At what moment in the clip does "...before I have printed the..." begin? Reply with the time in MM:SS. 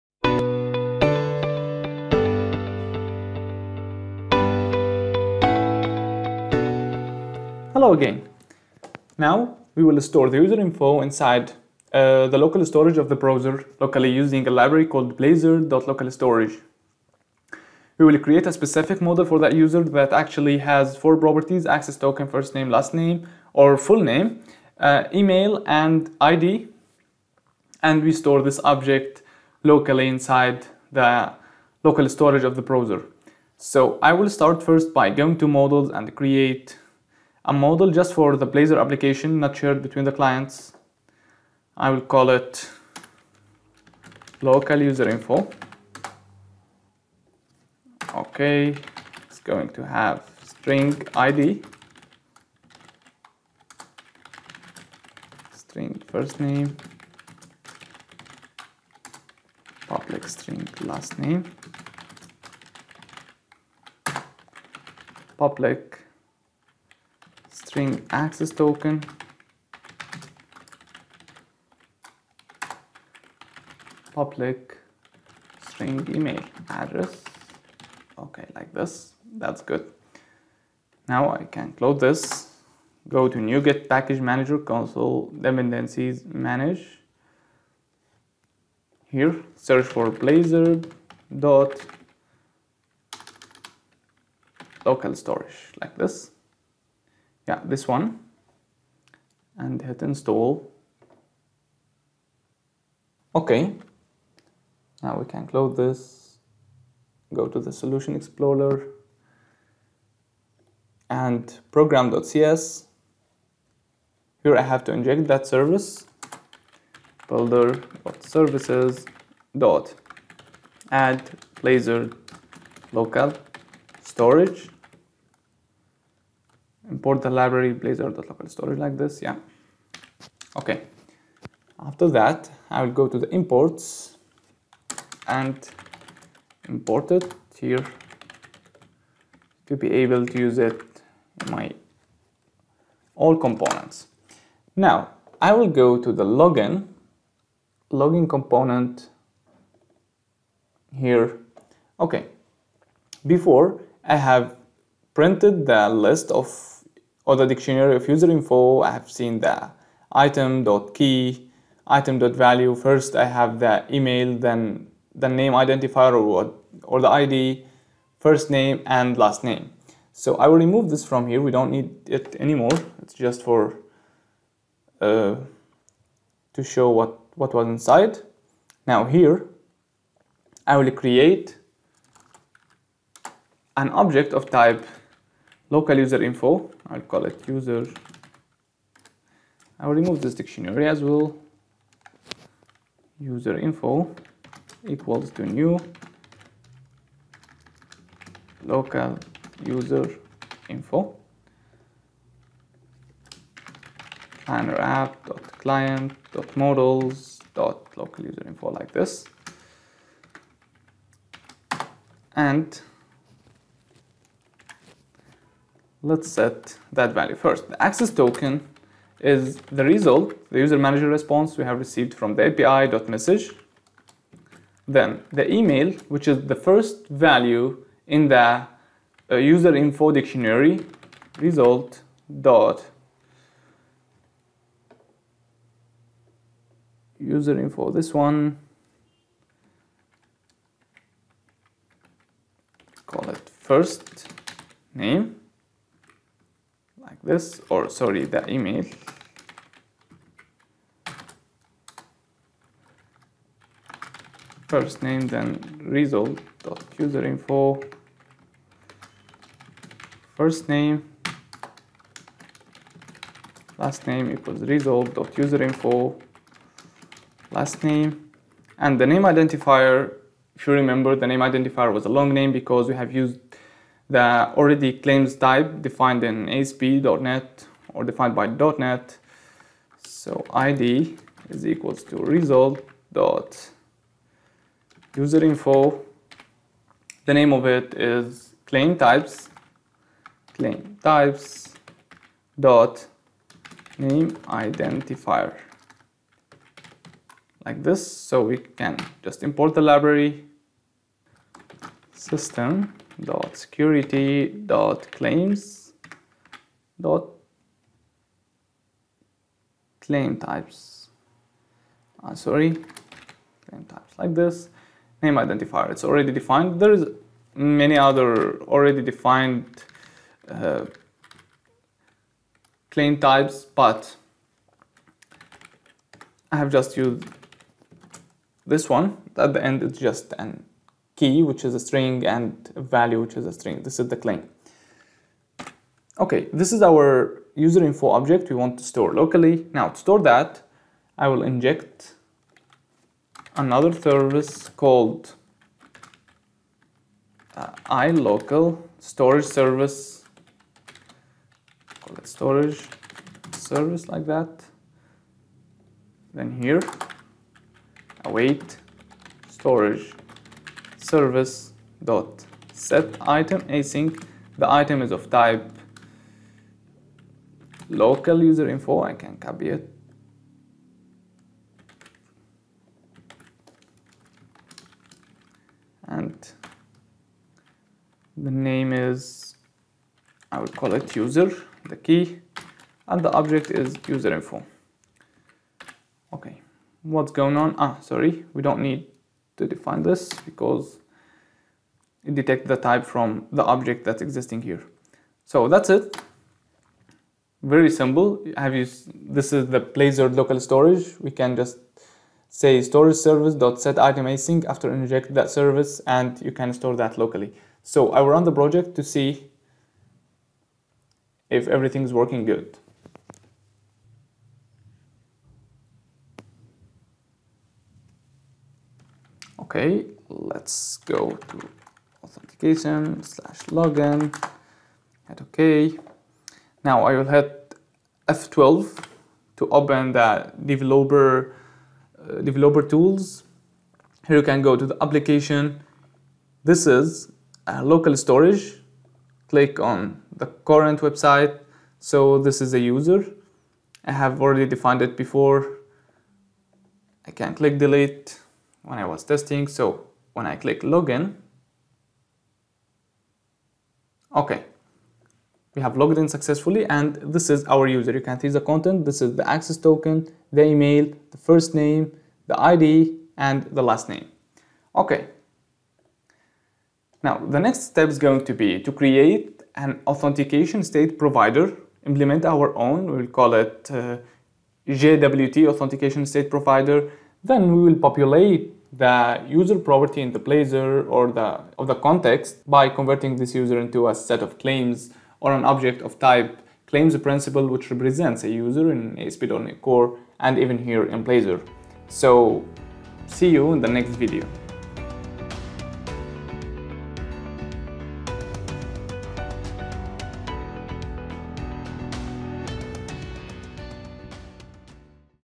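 02:33.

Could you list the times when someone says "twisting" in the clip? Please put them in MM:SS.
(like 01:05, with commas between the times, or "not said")
not said.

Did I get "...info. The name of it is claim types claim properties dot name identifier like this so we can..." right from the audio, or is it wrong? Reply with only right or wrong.
wrong.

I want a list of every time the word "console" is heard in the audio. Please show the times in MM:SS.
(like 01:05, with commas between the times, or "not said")
01:24.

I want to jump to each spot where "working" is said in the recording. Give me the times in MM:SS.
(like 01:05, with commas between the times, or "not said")
06:52.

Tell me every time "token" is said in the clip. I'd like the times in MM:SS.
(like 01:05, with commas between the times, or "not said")
00:21, 01:08, 03:38, 07:39.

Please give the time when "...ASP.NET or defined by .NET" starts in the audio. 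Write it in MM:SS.
04:36.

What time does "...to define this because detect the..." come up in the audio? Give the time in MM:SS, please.
06:29.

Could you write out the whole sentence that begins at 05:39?
Now, to store that, I will inject another service called uh, iLocal storage service.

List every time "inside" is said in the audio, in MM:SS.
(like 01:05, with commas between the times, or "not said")
00:11, 00:30, 02:57.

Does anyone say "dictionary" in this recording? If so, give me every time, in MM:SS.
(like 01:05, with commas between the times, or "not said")
02:37, 03:10, 03:50.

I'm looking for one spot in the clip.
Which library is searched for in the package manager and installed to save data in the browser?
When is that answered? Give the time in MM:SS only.
01:30.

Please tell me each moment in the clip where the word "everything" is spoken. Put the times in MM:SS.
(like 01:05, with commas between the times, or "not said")
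06:51.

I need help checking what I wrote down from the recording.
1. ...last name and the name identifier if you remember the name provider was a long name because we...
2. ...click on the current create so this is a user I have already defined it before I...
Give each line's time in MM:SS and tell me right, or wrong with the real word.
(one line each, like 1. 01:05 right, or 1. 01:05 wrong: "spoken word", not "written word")
1. 04:27 wrong: "identifier", not "provider"
2. 07:19 wrong: "website", not "create".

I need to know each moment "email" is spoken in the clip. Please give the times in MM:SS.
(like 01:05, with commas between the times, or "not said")
00:25, 01:16, 02:43, 03:45, 04:08, 07:40.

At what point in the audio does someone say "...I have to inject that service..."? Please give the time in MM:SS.
01:54.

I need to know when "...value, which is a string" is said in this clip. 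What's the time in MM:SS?
05:32.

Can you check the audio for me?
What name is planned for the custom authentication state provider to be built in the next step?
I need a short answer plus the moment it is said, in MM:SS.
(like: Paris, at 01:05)
JWT authentication state provider, at 07:54.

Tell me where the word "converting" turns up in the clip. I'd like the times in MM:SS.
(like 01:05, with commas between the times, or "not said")
08:02.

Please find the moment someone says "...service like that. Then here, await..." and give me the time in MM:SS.
05:53.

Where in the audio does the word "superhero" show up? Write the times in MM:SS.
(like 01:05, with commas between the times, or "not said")
not said.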